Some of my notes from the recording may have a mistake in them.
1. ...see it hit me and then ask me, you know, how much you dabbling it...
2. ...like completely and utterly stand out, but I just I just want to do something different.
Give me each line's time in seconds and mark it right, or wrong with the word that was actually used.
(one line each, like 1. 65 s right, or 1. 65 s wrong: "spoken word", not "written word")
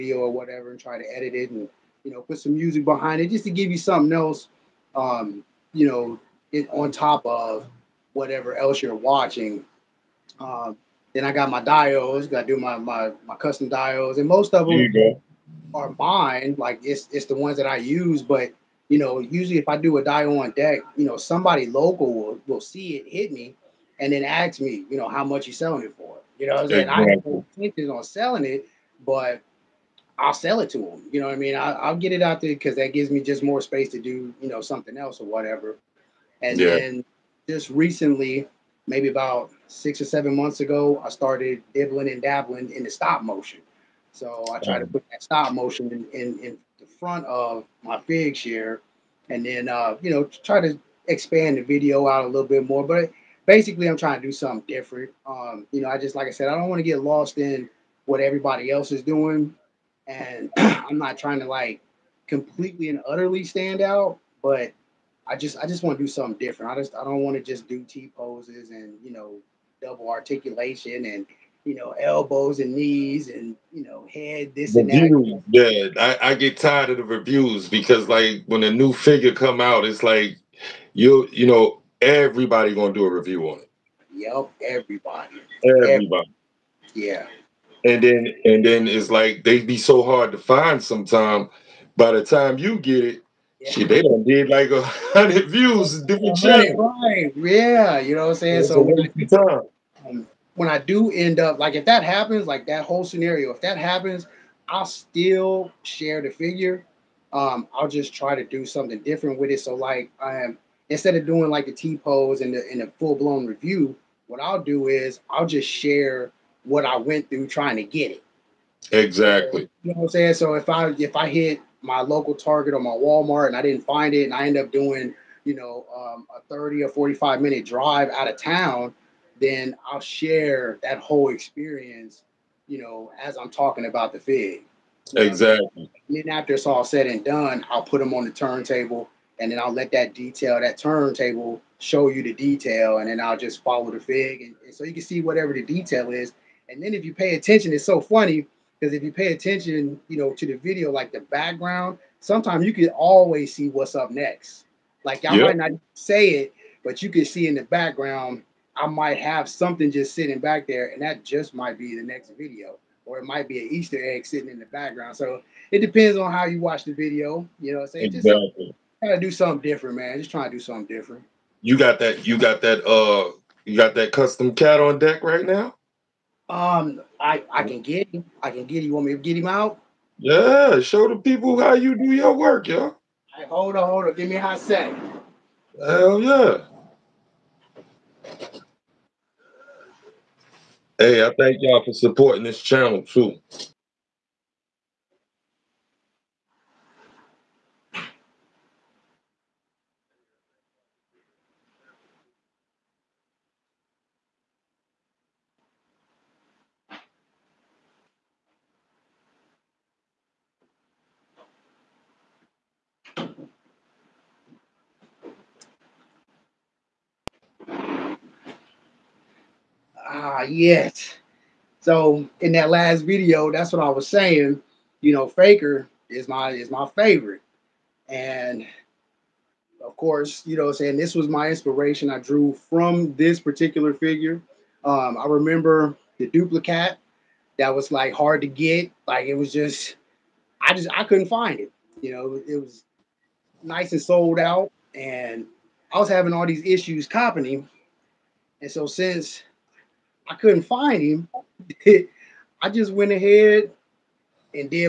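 1. 22 s wrong: "selling", not "dabbling"
2. 61 s right.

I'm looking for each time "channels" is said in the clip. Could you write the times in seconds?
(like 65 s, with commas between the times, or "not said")
96 s, 192 s.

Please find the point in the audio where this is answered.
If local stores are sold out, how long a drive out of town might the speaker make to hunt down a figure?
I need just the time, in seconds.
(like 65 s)
126 s.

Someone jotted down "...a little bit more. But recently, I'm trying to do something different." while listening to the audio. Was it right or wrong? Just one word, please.
wrong.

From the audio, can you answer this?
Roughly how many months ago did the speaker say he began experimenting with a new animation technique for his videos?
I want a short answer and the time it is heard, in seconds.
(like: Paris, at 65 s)
6 or 7 months, at 39 s.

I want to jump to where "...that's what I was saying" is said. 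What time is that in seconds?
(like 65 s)
223 s.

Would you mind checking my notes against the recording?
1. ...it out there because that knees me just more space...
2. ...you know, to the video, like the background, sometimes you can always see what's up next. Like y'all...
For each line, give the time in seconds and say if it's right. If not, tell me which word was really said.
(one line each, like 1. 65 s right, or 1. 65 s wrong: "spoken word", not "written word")
1. 32 s wrong: "gives", not "knees"
2. 150 s right.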